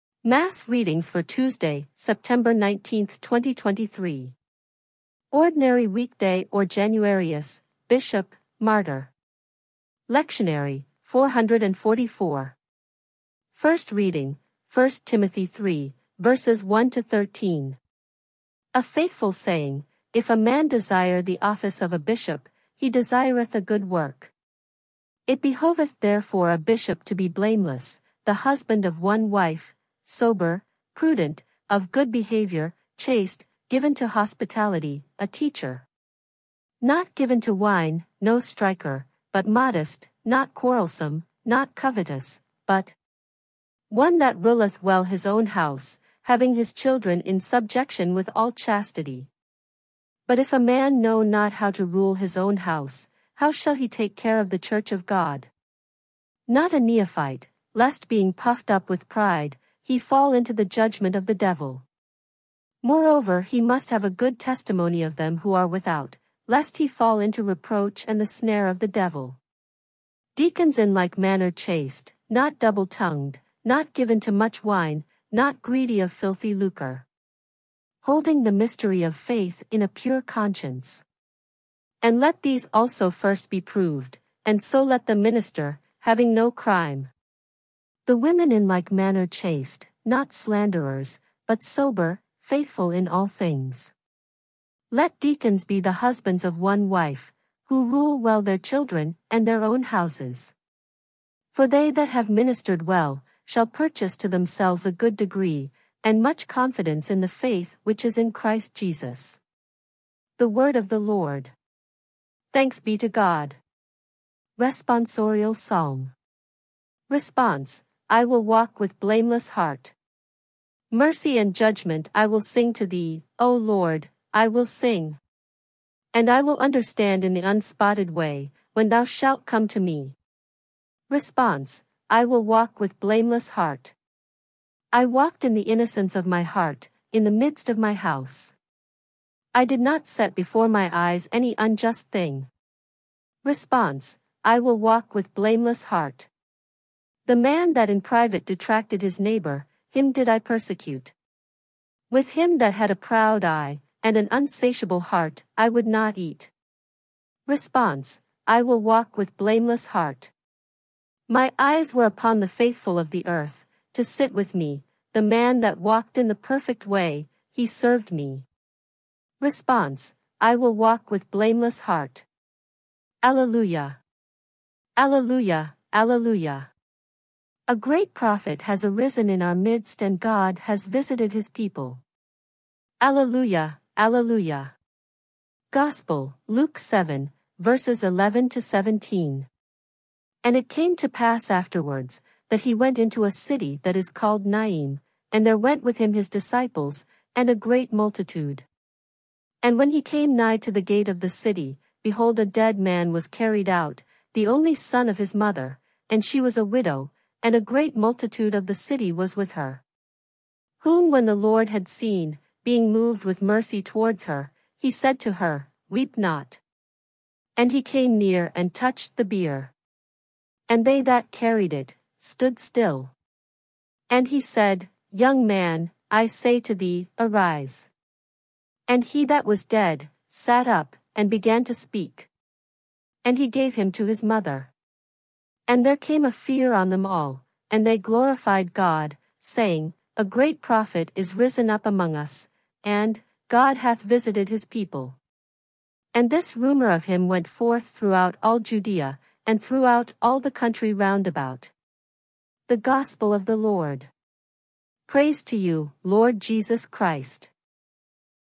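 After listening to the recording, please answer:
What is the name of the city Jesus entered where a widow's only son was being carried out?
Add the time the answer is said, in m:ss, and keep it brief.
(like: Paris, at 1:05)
Naim, at 3:14.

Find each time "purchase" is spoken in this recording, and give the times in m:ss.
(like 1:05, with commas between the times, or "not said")
1:43.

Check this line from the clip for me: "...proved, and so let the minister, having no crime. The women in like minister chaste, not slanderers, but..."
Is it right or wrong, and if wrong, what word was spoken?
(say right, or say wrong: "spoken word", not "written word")
wrong: "manner", not "minister".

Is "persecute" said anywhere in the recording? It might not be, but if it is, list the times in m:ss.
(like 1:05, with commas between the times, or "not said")
2:30.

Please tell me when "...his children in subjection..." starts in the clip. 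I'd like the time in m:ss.
0:46.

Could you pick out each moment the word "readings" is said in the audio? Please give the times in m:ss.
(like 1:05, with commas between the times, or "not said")
0:00, 0:13.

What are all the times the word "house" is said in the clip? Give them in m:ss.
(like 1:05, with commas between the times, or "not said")
0:45, 0:52, 1:39, 2:17.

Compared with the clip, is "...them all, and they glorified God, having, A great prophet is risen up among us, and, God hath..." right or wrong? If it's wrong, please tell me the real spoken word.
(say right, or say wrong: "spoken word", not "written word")
wrong: "saying", not "having".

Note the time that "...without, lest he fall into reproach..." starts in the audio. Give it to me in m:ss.
1:05.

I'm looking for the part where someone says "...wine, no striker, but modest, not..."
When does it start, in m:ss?
0:37.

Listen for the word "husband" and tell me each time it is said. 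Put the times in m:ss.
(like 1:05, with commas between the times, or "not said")
0:28, 1:35.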